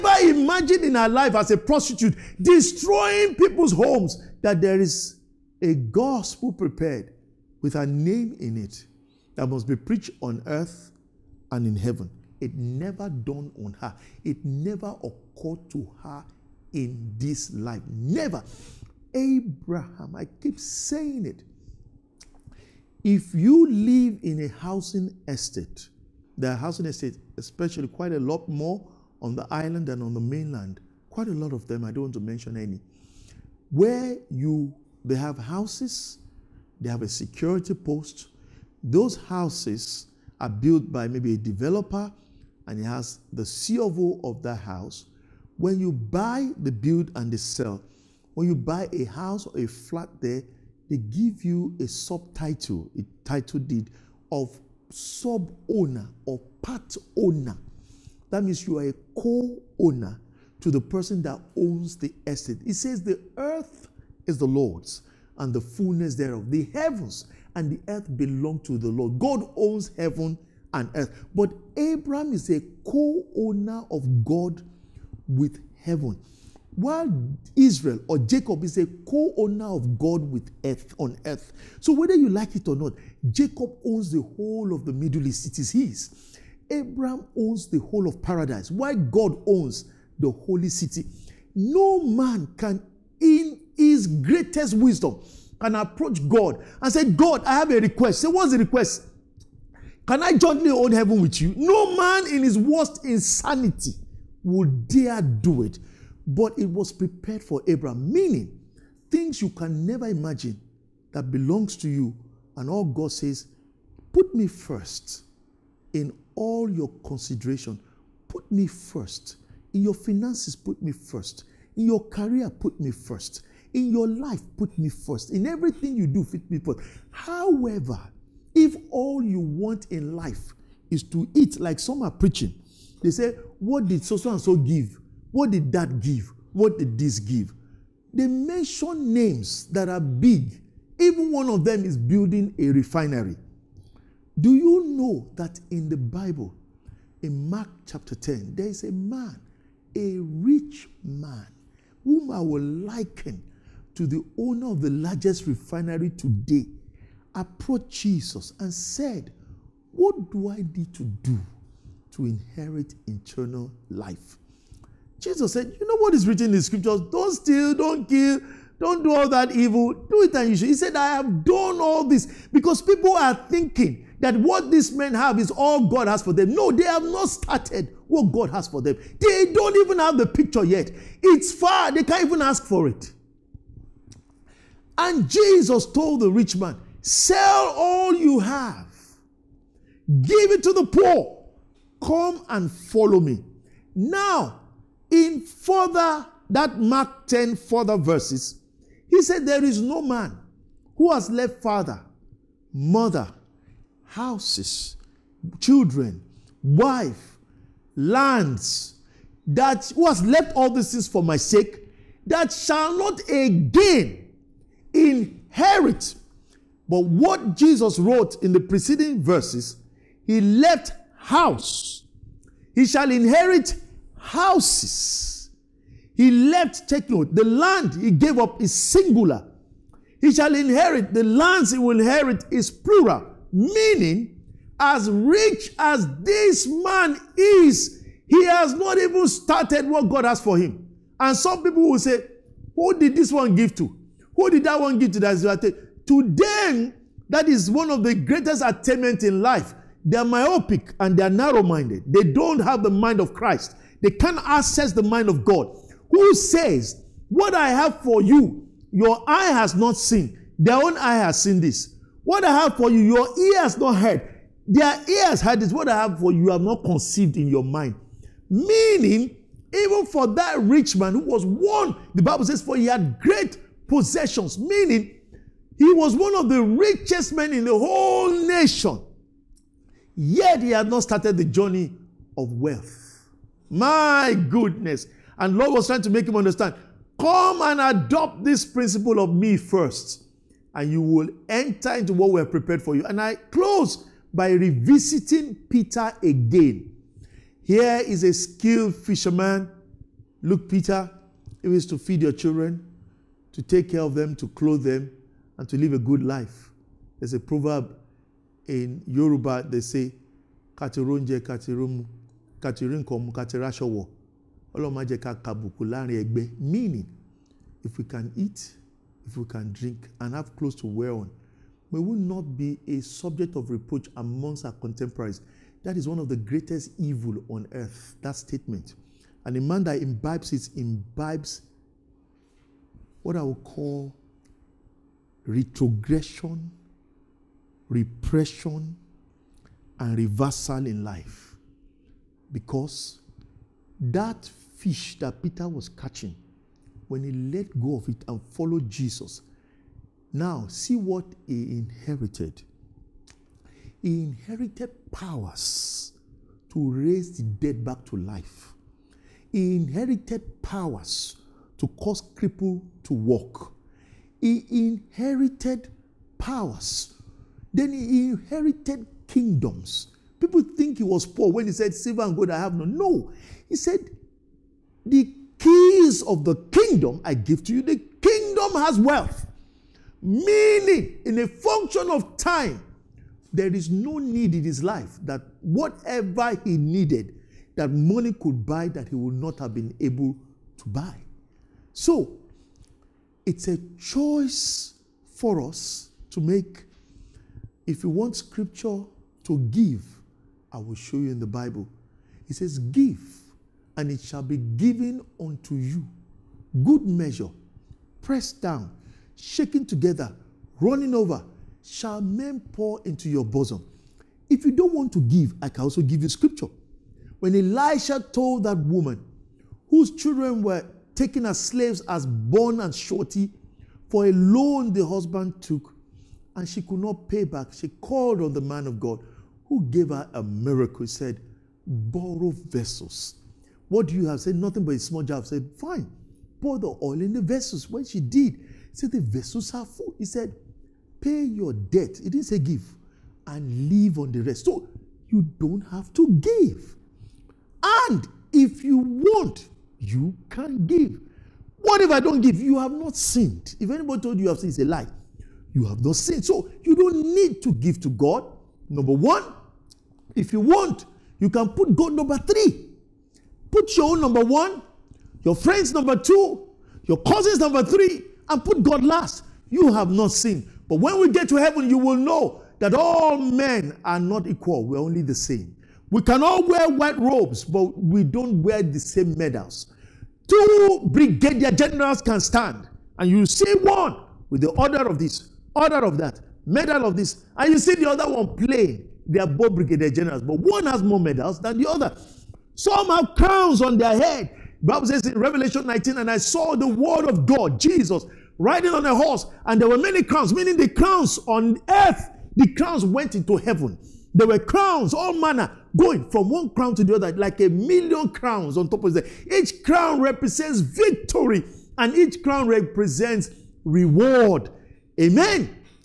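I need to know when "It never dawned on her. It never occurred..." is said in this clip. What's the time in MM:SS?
00:12.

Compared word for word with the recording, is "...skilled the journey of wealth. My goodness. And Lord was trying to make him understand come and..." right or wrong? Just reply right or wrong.
wrong.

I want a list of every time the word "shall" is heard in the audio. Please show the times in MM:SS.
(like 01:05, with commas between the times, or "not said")
03:32, 03:42, 03:50, 06:44, 06:51.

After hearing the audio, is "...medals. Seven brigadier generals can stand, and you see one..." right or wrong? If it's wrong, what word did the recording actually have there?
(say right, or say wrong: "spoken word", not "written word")
wrong: "Two", not "Seven".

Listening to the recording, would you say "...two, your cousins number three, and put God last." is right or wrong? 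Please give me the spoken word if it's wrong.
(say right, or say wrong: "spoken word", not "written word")
right.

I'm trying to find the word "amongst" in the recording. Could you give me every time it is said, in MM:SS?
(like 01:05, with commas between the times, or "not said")
05:24.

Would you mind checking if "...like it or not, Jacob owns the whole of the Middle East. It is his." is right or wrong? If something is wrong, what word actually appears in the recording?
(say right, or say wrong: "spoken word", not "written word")
right.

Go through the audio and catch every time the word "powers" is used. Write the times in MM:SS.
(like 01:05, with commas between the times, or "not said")
05:55, 06:00, 06:06.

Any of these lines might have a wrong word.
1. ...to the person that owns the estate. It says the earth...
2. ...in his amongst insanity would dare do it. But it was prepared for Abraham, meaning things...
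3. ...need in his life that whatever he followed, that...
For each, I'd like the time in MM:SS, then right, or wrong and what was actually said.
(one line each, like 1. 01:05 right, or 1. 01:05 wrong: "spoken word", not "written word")
1. 01:00 right
2. 01:42 wrong: "worst", not "amongst"
3. 06:24 wrong: "needed", not "followed".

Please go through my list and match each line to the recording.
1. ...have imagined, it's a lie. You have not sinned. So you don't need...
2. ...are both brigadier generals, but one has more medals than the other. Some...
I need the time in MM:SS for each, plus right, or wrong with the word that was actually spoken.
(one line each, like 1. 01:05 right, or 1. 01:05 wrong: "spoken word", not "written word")
1. 07:34 wrong: "sinned", not "imagined"
2. 08:09 right.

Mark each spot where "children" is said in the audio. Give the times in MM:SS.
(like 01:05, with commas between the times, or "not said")
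03:25, 05:02, 07:00.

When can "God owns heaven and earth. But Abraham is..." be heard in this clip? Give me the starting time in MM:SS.
01:09.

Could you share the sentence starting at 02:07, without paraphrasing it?
However, if all you want in life is to eat, like some are preaching, they say, What did so and so give?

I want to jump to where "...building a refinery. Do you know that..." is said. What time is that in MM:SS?
02:21.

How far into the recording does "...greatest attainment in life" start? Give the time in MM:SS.
04:08.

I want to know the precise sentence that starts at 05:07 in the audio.
There's a proverb in Yoruba, they say, Katironje katirum katirinkom katirashowo.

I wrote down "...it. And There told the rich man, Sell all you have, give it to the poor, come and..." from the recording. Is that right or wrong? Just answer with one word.
wrong.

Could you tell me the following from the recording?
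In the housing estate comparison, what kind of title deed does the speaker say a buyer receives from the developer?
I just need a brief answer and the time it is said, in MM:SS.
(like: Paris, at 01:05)
Subtitle, at 00:51.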